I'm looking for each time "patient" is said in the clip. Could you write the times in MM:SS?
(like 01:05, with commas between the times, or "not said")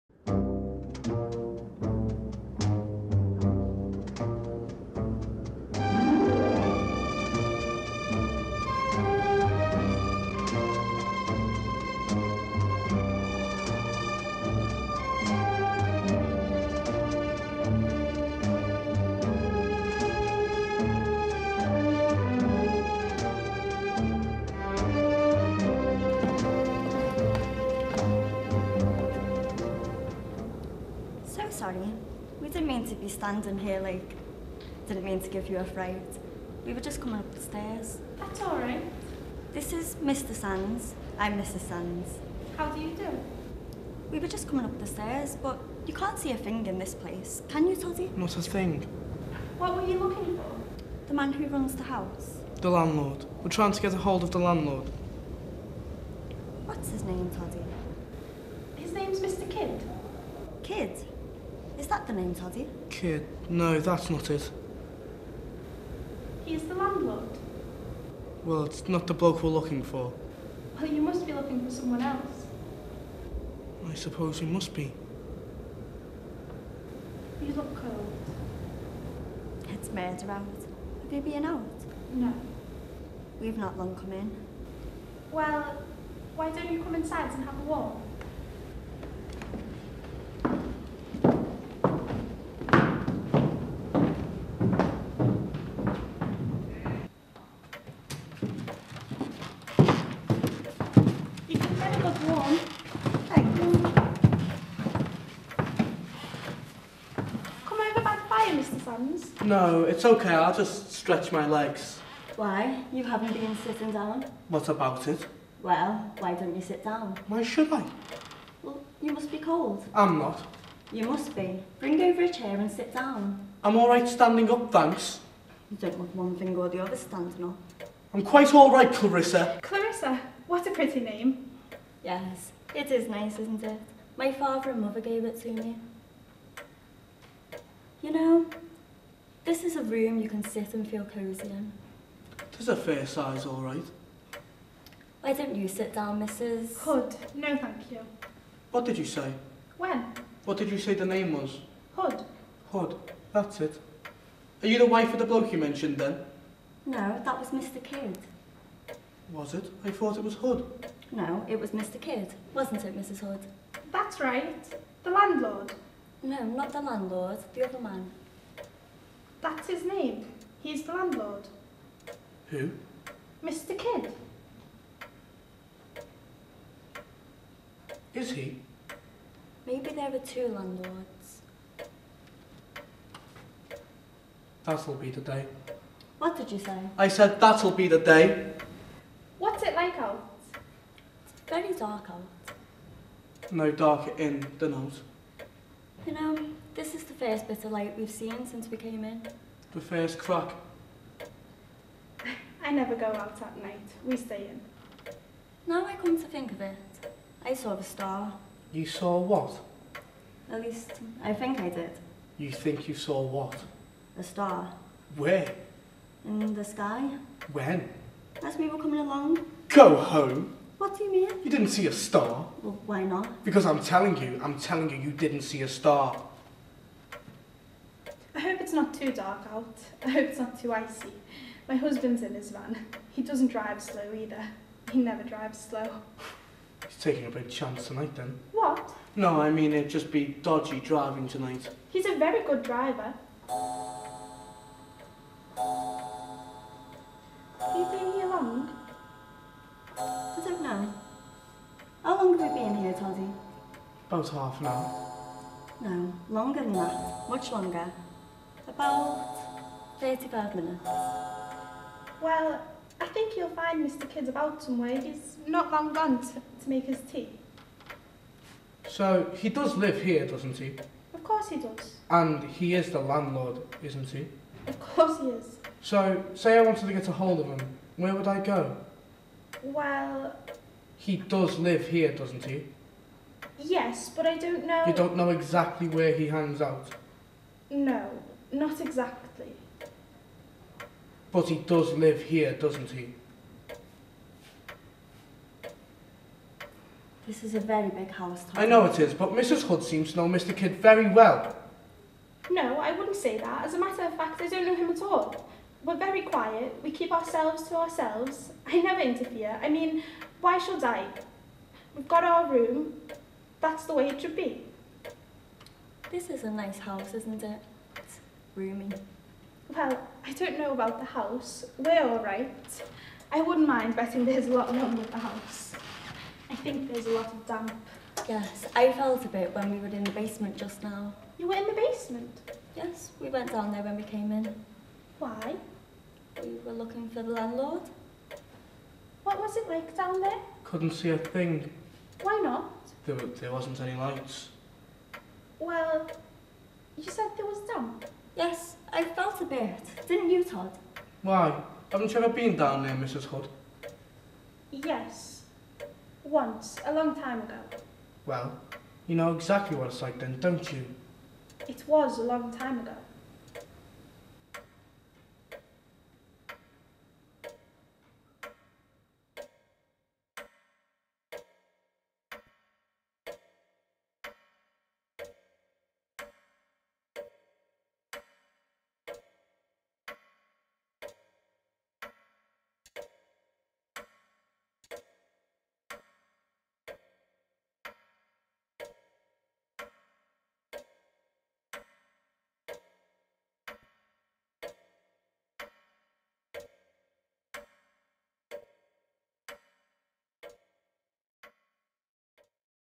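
not said.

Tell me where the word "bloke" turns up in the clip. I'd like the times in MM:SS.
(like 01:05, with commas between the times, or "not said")
01:09, 02:35.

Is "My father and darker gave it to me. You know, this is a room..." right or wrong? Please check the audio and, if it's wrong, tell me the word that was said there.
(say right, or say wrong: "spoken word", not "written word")
wrong: "mother", not "darker".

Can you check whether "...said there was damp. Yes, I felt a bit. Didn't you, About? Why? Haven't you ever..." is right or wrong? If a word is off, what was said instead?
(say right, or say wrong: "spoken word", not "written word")
wrong: "Todd", not "About".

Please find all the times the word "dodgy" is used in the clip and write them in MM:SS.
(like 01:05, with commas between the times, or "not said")
04:00.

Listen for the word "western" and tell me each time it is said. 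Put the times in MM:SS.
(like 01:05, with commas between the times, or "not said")
not said.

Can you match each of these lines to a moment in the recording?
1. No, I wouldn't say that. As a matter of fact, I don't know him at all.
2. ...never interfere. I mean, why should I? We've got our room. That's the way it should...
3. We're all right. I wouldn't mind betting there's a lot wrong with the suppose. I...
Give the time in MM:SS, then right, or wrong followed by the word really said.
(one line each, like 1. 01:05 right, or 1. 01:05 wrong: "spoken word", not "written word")
1. 05:02 right
2. 05:08 right
3. 05:21 wrong: "house", not "suppose".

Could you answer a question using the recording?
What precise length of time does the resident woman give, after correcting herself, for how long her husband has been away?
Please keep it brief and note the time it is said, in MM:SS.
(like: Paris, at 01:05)
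35 minutes, at 04:18.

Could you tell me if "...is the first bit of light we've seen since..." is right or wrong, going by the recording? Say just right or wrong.
right.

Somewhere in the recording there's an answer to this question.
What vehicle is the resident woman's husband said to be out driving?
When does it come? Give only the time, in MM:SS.
03:52.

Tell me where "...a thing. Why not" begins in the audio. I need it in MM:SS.
05:41.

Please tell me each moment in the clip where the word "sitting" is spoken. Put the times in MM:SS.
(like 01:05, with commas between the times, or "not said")
01:53.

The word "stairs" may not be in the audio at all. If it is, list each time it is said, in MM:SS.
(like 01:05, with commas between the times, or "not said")
00:37, 00:44.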